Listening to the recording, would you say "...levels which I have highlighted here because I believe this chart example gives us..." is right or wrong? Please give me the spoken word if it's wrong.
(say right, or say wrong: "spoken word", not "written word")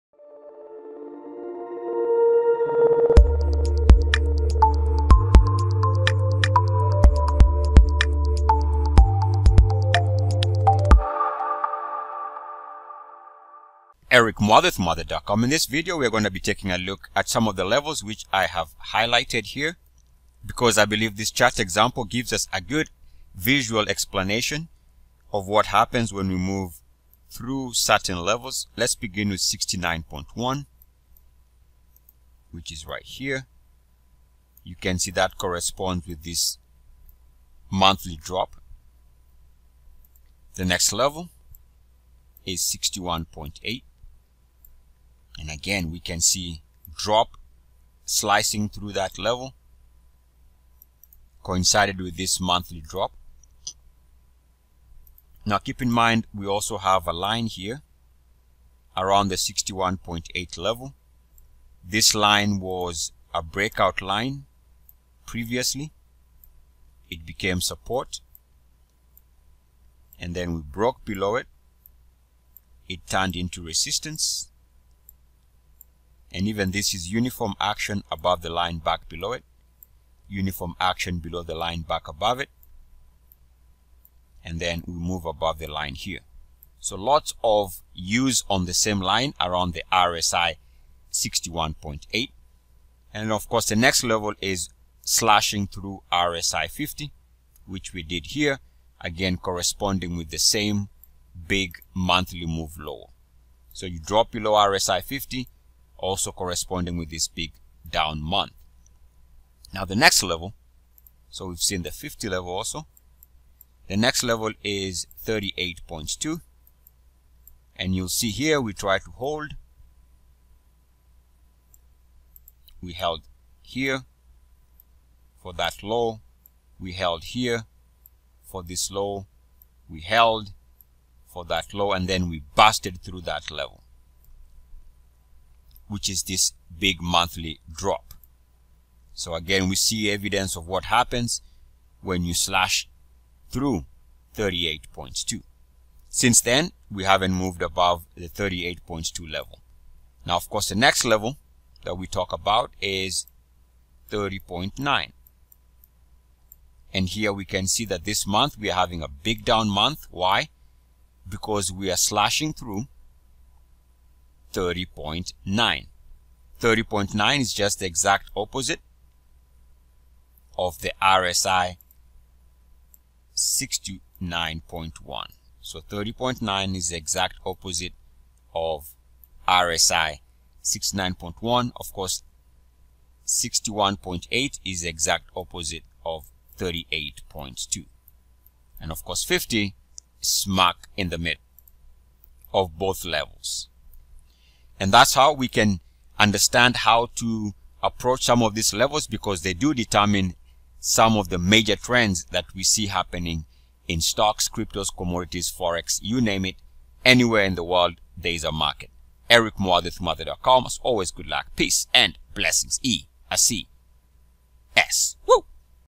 right.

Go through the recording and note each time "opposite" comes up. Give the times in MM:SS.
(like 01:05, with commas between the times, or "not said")
02:48, 02:57, 03:05.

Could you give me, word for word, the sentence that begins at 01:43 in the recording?
So you drop below RSI 50, also corresponding with this big down month.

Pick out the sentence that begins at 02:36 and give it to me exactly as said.
And here we can see that this month we are having a big down month.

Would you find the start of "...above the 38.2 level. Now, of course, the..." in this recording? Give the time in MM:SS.
02:27.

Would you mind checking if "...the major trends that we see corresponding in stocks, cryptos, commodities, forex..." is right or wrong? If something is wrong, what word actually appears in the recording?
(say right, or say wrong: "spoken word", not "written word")
wrong: "happening", not "corresponding".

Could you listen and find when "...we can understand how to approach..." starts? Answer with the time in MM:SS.
03:15.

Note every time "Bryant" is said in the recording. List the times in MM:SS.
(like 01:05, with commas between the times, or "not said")
not said.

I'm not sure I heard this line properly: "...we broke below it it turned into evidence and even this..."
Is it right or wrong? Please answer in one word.
wrong.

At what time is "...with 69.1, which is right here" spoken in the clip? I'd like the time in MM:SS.
00:29.